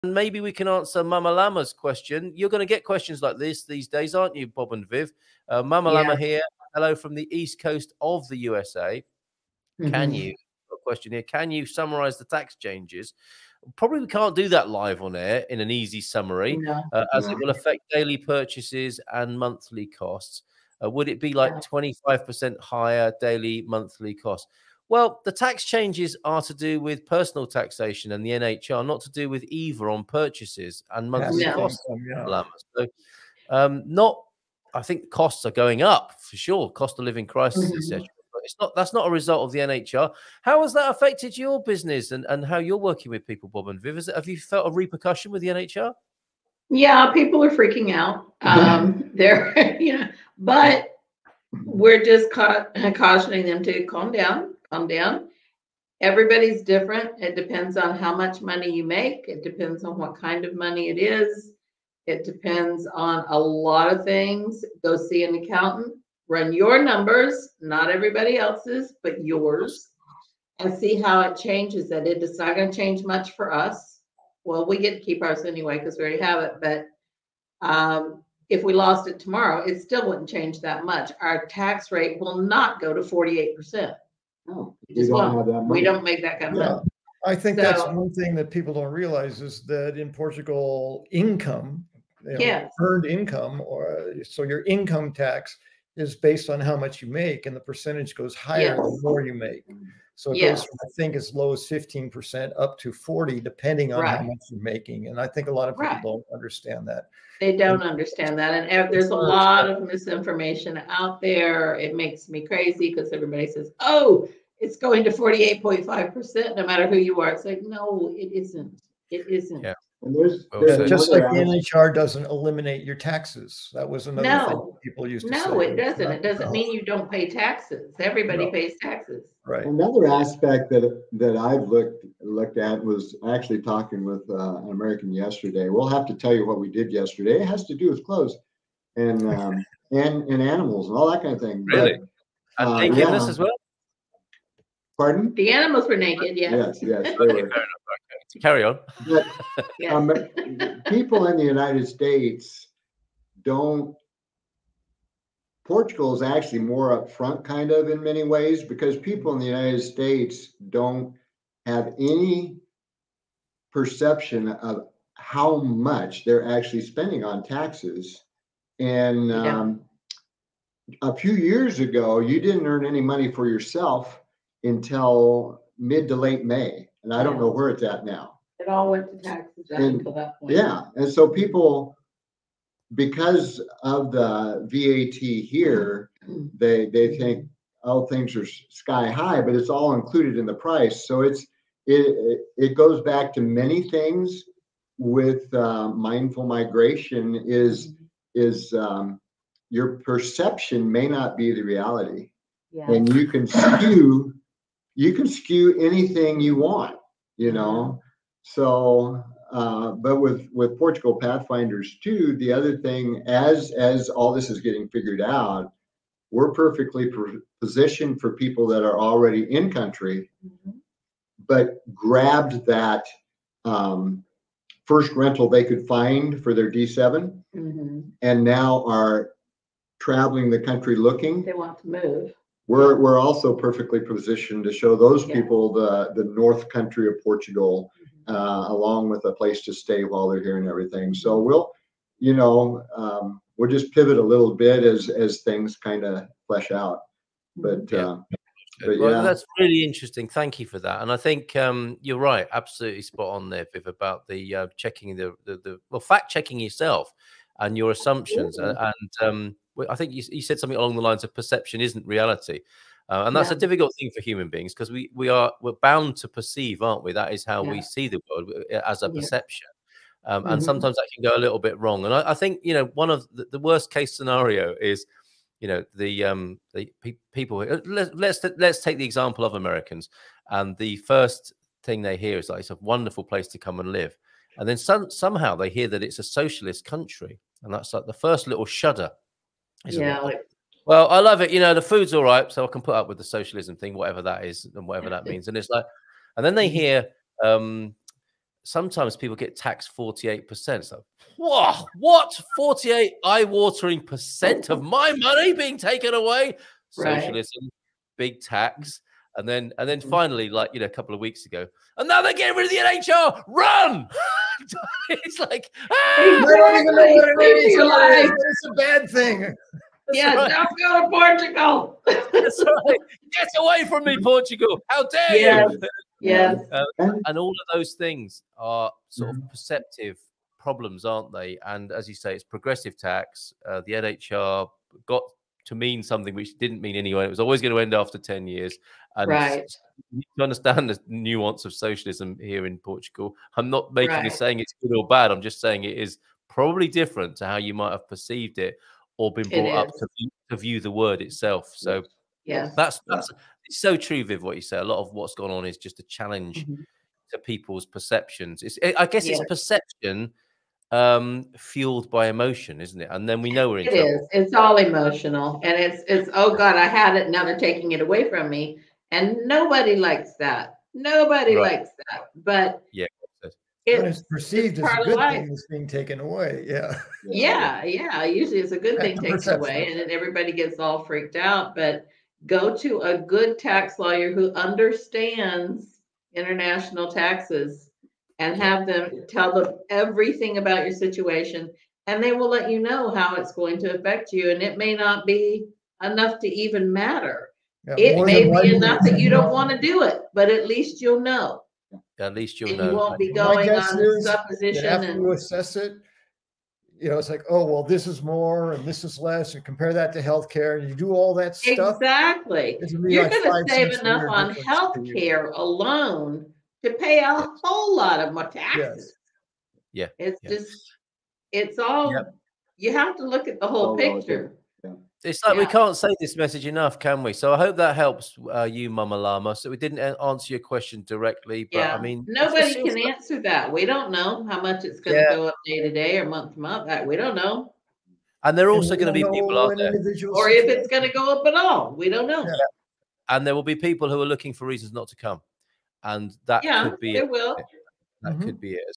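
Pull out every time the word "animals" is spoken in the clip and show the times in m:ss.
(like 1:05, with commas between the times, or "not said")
2:20, 2:25.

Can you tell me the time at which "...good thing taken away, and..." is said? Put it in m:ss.
6:18.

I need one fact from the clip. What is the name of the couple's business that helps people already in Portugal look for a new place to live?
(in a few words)
Portugal Pathfinders.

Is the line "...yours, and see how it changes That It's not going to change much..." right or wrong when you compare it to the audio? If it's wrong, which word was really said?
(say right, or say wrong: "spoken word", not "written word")
right.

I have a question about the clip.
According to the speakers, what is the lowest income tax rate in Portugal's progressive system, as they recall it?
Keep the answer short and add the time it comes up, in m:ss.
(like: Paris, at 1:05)
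15%, at 1:41.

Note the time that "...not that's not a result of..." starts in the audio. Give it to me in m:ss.
0:38.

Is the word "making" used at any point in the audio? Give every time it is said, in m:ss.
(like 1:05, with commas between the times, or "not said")
1:44, 5:43.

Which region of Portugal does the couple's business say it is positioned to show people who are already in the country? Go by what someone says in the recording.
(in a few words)
The north.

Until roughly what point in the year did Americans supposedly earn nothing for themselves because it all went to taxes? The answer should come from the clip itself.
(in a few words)
Mid to late May.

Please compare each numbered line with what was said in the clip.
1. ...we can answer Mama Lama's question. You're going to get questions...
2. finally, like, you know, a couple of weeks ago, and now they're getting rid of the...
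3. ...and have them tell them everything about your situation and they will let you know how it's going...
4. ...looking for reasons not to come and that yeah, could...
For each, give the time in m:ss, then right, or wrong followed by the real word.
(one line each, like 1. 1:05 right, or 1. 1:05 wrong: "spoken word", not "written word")
1. 0:00 right
2. 5:10 right
3. 6:28 right
4. 7:24 right.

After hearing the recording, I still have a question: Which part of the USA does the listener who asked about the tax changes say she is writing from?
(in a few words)
East coast.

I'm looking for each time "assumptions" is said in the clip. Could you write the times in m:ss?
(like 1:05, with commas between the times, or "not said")
4:17.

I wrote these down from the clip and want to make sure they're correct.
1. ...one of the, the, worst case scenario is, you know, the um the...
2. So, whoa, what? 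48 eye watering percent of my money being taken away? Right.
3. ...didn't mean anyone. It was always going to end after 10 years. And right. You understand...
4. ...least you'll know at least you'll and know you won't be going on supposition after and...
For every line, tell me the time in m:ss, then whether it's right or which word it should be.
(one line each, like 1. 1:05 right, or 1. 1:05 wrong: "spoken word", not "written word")
1. 4:33 right
2. 5:00 right
3. 5:36 right
4. 6:40 right.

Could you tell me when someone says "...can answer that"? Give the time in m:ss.
7:12.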